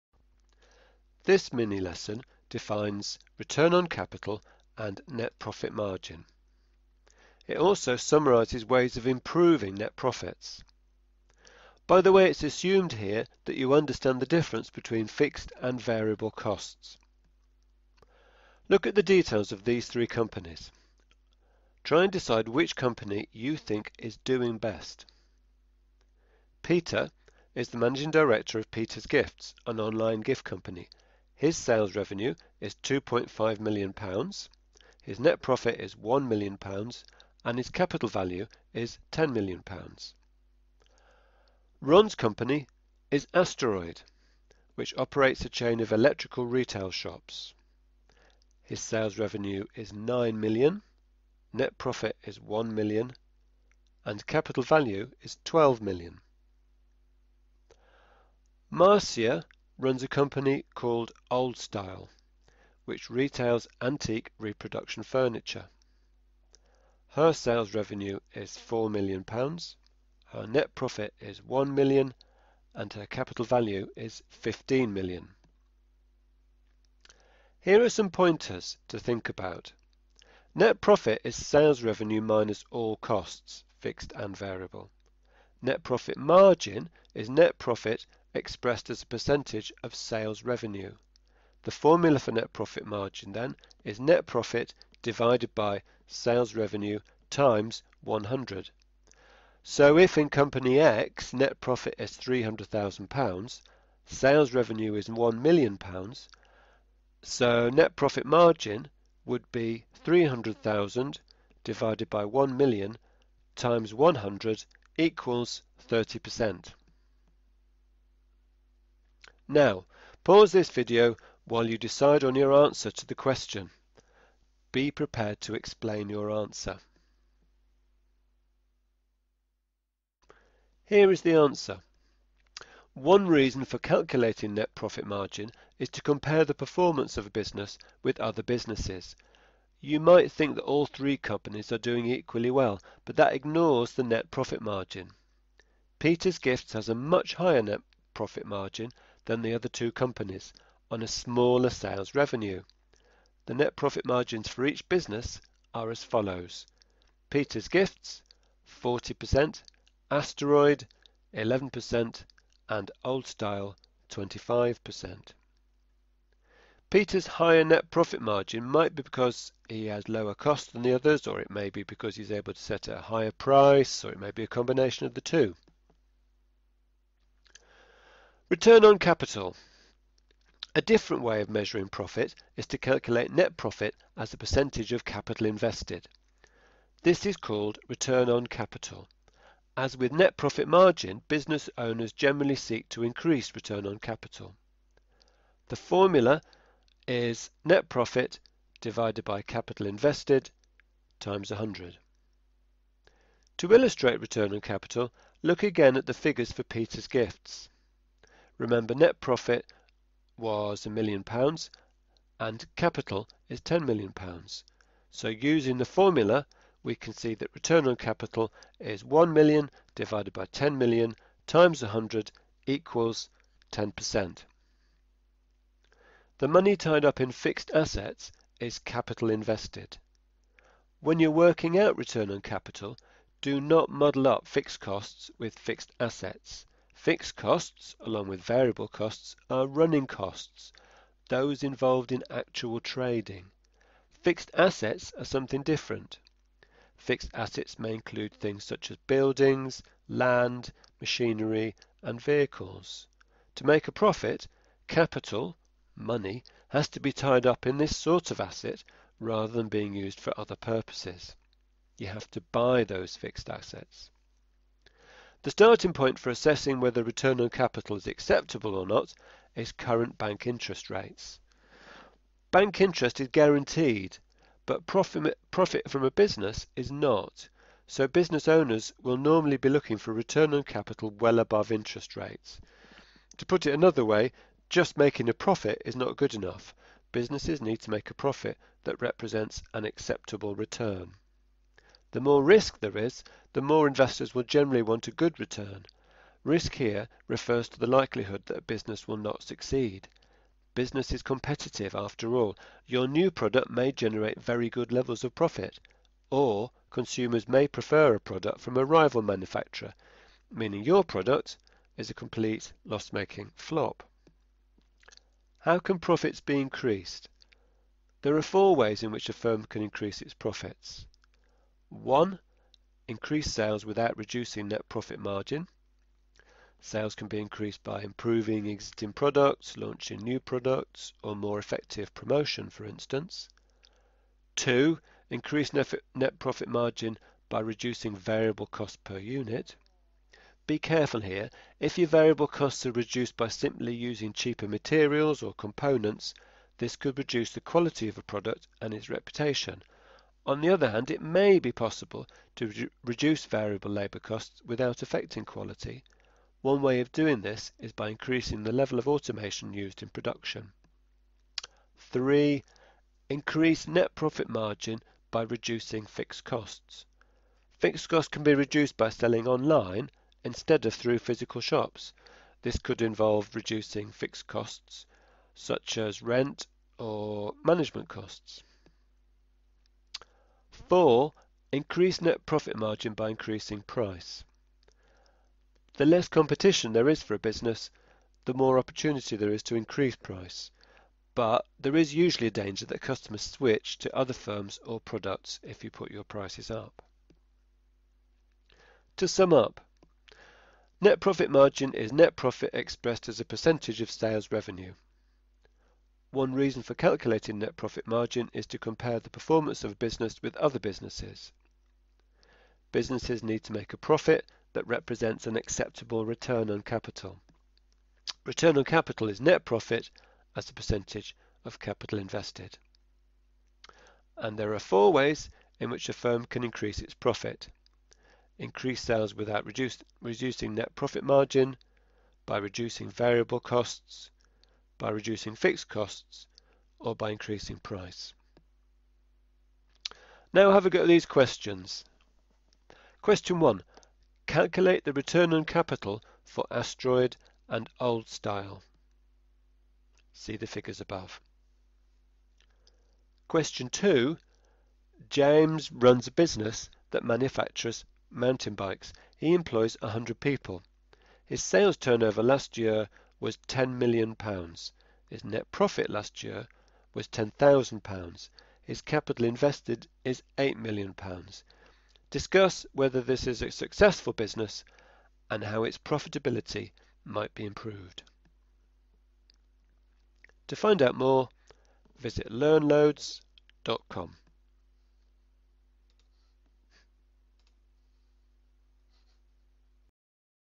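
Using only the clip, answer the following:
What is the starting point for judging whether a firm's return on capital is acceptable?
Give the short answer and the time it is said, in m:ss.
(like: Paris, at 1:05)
Current bank interest rates, at 4:29.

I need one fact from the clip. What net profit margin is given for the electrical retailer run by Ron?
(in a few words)
11%.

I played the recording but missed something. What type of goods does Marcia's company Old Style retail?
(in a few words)
Antique reproduction furniture.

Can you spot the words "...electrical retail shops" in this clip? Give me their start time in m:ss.
0:45.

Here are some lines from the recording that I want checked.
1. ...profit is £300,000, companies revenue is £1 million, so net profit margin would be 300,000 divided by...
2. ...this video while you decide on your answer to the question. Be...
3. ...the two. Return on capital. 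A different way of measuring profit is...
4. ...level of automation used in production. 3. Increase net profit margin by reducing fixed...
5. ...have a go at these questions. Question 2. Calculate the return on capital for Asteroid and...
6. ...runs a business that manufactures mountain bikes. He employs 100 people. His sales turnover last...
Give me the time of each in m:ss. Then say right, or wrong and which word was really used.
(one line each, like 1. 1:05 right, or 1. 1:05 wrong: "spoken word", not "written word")
1. 1:41 wrong: "sales", not "companies"
2. 2:00 right
3. 2:55 right
4. 5:58 right
5. 7:20 wrong: "1", not "2"
6. 7:35 right.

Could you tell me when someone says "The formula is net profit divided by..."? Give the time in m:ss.
3:15.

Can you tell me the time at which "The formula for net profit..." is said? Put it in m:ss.
1:31.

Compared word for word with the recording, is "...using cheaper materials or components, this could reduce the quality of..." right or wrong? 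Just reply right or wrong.
right.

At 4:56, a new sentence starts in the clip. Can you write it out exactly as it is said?
Risk here refers to the likelihood that a business will not succeed.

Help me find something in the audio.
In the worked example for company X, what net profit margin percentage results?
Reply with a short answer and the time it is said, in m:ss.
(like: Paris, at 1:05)
30%, at 1:55.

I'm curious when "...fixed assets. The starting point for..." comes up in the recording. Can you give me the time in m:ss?
4:23.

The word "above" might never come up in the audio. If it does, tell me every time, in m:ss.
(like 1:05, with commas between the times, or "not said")
4:41, 7:31.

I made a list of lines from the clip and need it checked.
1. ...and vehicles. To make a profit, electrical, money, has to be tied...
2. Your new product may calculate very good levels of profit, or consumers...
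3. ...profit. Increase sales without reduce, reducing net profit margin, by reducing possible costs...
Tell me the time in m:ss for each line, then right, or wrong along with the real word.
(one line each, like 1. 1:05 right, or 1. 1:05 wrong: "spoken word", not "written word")
1. 4:12 wrong: "capital", not "electrical"
2. 5:02 wrong: "generate", not "calculate"
3. 7:07 wrong: "variable", not "possible".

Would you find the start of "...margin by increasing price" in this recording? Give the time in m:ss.
6:22.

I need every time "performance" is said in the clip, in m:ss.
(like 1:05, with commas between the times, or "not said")
2:16, 6:49.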